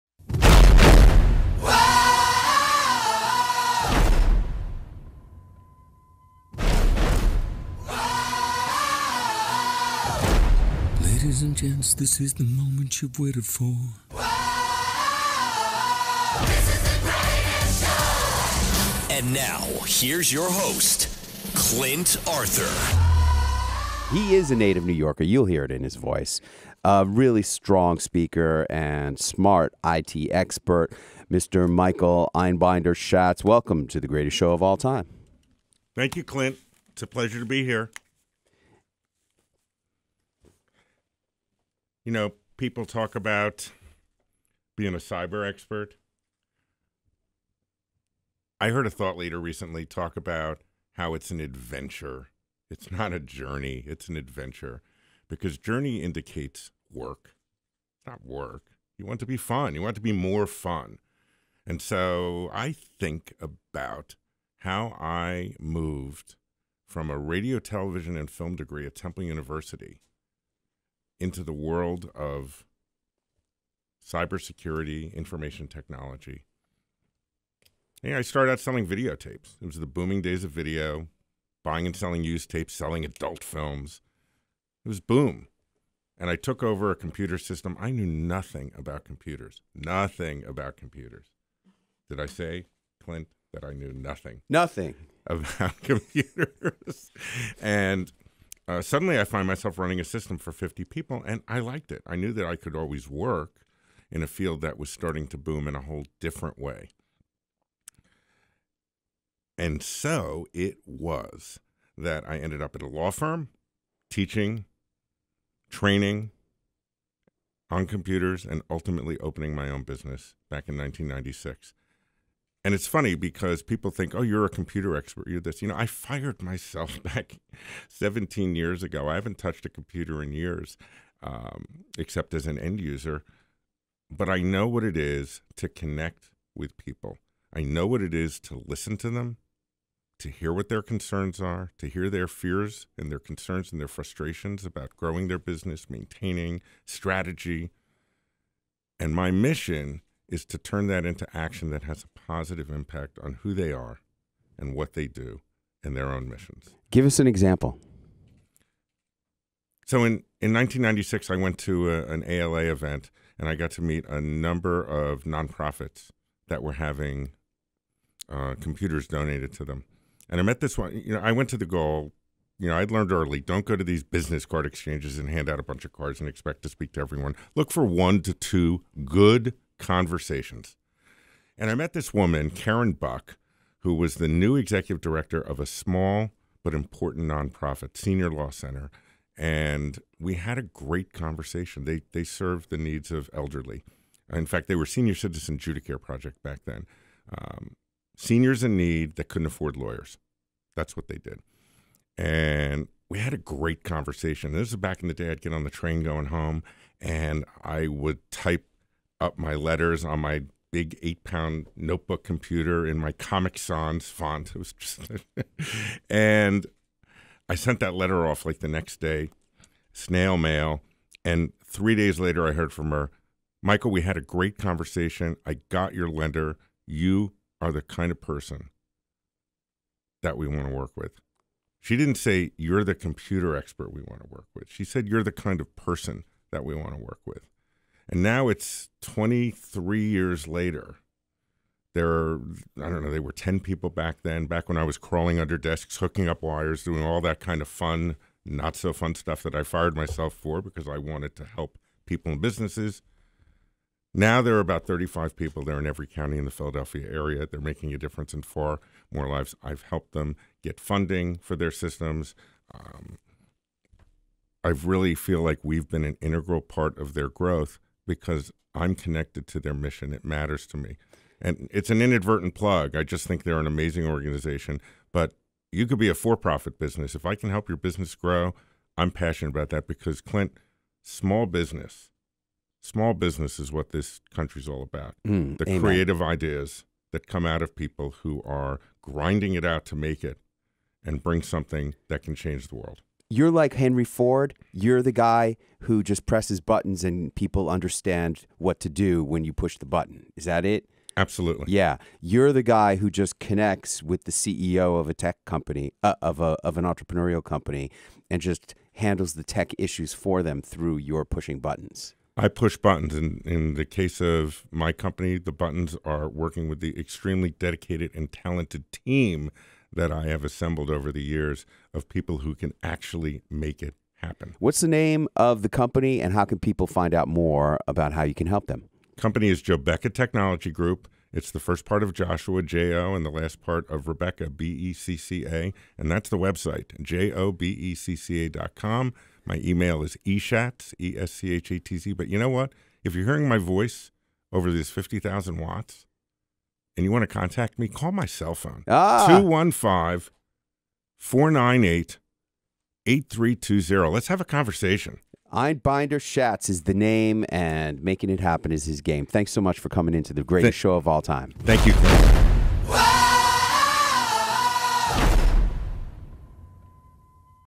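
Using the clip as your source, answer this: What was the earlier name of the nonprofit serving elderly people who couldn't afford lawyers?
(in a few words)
Senior Citizen Judicare Project.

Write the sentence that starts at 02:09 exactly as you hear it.
I haven't touched a computer in years, um, except as an end user.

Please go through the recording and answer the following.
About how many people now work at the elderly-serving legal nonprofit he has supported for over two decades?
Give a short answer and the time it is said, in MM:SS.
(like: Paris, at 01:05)
35, at 04:14.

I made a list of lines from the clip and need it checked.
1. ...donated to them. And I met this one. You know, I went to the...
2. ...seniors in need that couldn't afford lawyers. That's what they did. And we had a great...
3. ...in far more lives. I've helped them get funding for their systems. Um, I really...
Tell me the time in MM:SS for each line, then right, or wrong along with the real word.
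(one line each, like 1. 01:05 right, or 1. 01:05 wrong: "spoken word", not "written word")
1. 02:49 right
2. 03:18 right
3. 04:18 right.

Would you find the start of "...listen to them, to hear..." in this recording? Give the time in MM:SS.
02:18.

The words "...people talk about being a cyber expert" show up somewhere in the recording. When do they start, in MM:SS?
00:42.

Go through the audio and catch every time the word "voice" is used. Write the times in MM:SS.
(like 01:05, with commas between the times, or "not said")
00:25, 05:43.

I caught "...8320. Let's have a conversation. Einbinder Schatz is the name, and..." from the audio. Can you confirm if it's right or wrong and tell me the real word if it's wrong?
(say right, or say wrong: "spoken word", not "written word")
right.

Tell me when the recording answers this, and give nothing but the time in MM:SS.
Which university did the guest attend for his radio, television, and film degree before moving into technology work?
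01:08.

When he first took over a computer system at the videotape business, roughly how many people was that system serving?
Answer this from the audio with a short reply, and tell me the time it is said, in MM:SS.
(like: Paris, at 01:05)
50, at 01:40.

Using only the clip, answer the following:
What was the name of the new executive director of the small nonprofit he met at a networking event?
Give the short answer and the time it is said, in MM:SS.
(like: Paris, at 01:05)
Karen Buck, at 03:02.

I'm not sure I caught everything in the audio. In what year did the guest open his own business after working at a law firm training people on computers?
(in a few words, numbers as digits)
1996.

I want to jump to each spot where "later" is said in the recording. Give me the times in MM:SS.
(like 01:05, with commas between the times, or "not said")
03:42, 04:00.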